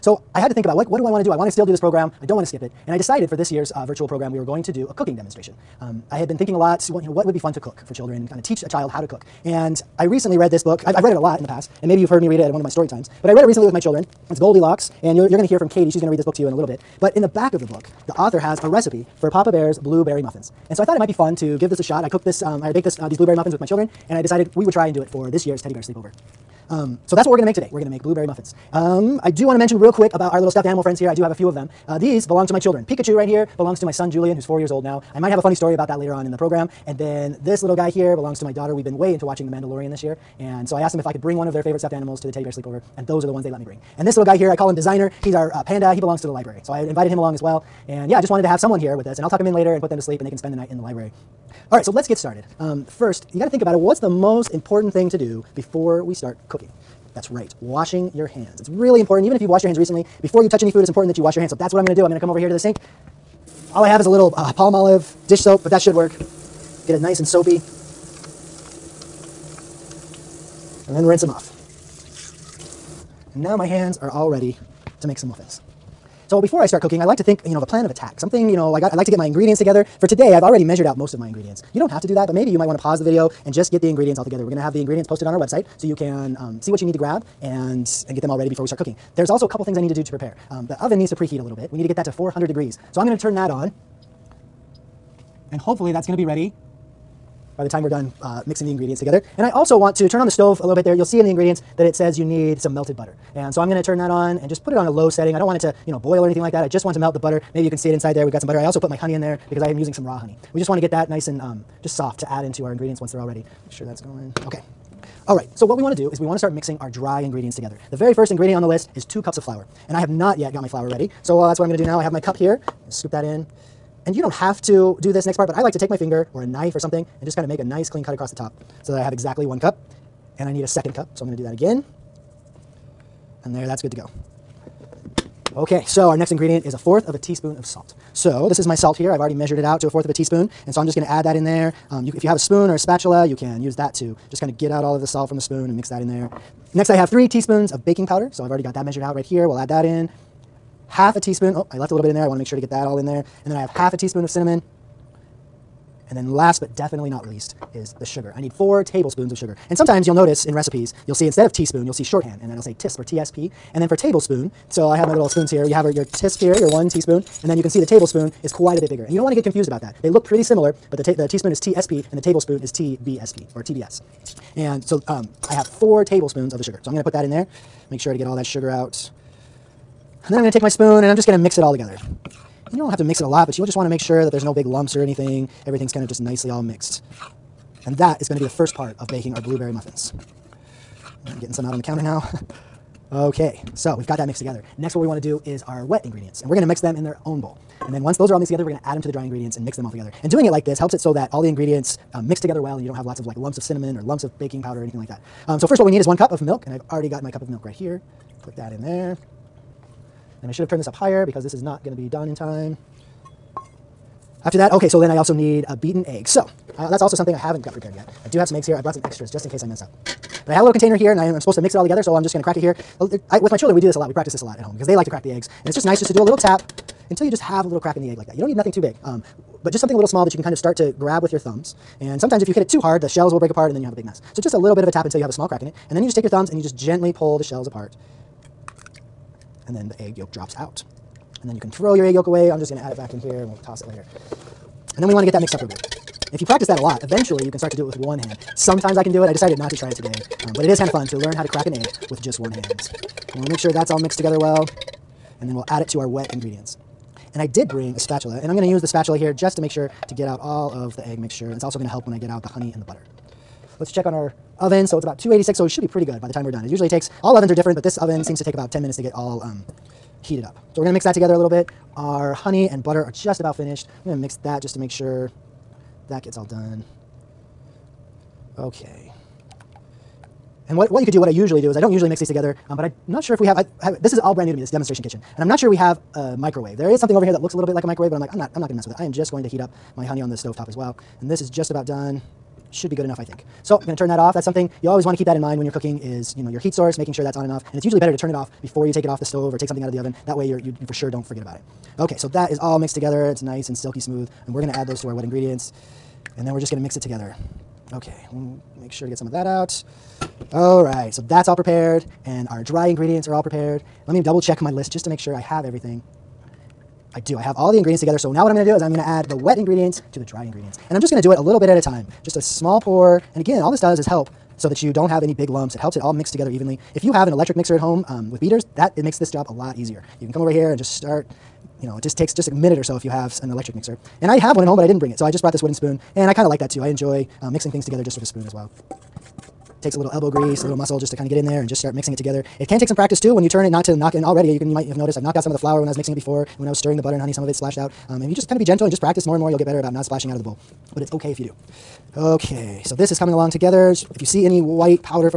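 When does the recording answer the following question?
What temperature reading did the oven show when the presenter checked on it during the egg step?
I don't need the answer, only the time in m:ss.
4:25.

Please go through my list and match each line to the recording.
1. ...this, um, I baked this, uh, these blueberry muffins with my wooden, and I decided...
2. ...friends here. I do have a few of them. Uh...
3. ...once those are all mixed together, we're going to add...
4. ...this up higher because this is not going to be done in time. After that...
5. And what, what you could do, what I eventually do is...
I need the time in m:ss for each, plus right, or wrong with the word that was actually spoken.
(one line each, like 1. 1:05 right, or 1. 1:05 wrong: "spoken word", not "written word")
1. 0:22 wrong: "children", not "wooden"
2. 0:30 right
3. 3:18 right
4. 3:30 right
5. 4:40 wrong: "usually", not "eventually".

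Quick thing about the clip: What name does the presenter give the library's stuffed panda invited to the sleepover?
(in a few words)
Designer.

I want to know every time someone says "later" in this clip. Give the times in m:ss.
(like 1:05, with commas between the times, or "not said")
0:35, 0:49, 4:03.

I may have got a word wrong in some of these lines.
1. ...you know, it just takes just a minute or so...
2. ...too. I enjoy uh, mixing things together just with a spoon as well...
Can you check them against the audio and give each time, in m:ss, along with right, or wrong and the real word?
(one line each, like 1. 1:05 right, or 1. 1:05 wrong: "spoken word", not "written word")
1. 5:31 right
2. 5:36 right.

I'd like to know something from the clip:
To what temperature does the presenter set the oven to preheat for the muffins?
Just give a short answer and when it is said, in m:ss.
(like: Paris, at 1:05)
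400 degrees, at 1:32.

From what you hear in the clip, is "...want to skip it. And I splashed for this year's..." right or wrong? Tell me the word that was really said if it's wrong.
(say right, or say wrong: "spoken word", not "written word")
wrong: "decided", not "splashed".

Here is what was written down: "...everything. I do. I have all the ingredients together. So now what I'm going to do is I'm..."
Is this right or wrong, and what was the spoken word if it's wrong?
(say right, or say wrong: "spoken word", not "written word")
right.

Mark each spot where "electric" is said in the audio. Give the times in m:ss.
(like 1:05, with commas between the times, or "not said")
5:27, 5:33.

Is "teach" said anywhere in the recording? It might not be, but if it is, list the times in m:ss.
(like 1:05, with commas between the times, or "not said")
0:08.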